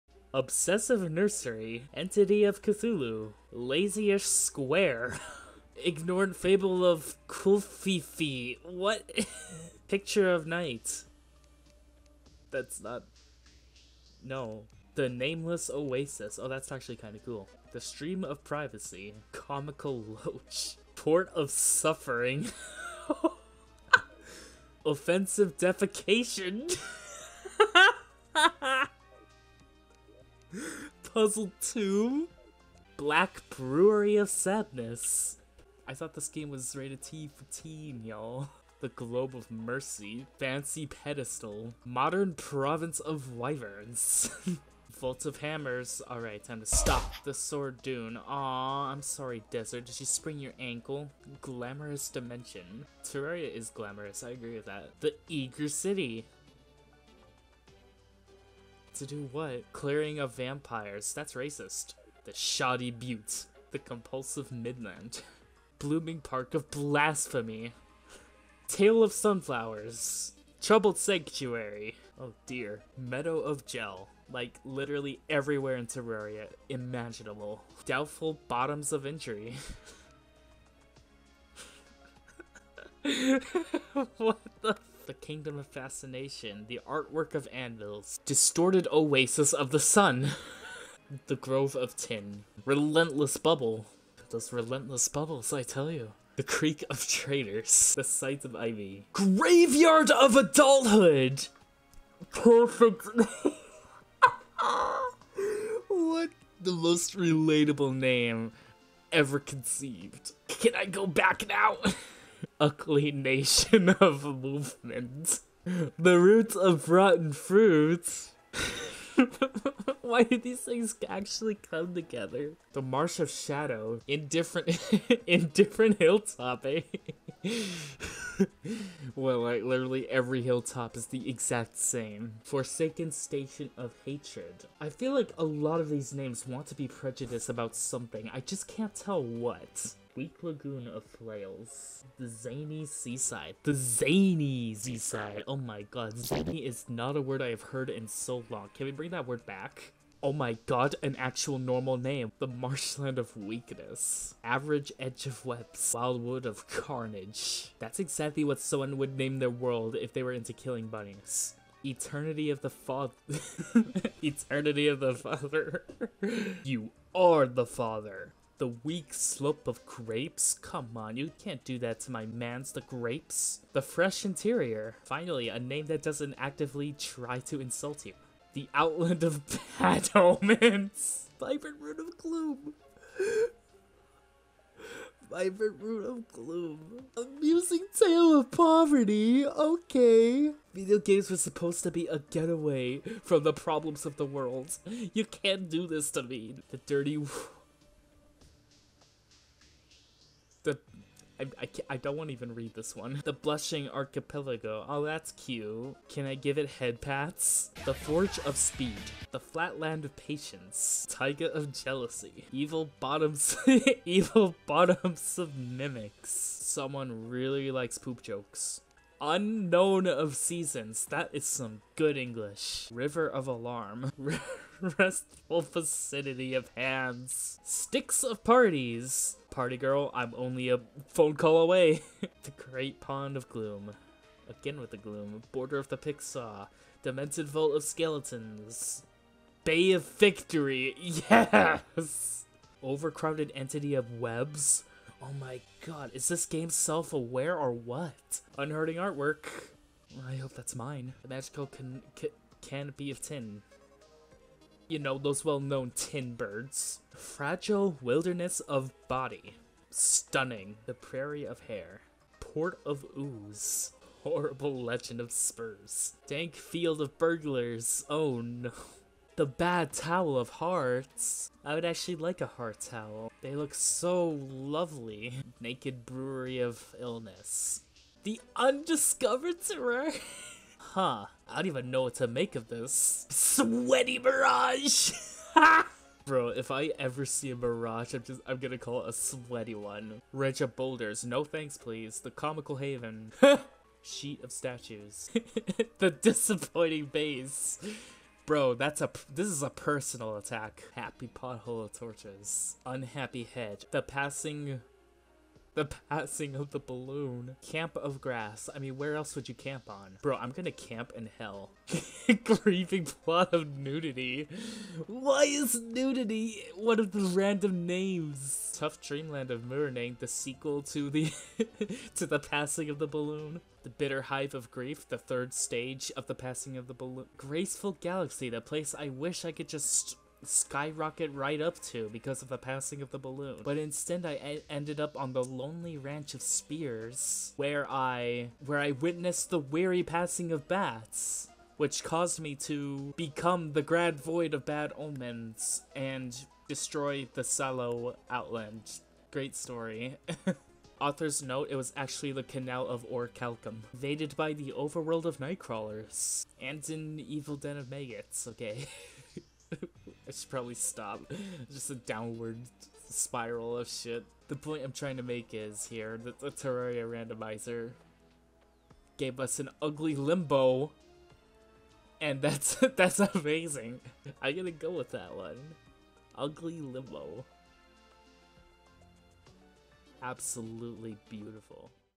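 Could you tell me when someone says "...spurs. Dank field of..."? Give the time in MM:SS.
04:25.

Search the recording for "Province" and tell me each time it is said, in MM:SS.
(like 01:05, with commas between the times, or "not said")
00:42.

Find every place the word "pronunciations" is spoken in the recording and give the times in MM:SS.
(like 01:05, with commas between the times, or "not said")
not said.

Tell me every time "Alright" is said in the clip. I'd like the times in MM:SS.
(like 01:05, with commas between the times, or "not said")
00:46.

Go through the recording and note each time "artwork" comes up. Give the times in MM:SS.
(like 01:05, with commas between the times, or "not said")
01:26, 04:08.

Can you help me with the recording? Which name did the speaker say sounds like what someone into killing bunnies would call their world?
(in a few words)
Wildwood of carnage.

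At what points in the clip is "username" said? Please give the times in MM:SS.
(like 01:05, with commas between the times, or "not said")
not said.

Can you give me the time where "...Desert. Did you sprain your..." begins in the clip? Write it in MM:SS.
00:49.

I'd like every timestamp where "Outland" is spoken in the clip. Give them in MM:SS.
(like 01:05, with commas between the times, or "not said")
02:58, 05:48.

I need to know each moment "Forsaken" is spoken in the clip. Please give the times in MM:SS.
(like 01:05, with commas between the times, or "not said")
02:12.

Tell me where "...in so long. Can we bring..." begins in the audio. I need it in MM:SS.
02:27.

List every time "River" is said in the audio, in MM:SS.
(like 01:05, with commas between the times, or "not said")
03:42.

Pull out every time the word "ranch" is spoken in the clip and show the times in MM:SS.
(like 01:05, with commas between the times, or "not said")
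04:50, 05:35.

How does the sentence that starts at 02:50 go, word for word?
Come on, you can't do that to my man's the grapes.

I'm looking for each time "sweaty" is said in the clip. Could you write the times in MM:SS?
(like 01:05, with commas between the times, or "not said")
04:43, 04:49.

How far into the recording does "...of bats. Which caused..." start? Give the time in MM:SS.
05:40.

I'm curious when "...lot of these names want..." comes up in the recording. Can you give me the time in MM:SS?
02:15.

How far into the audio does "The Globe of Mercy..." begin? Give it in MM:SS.
00:38.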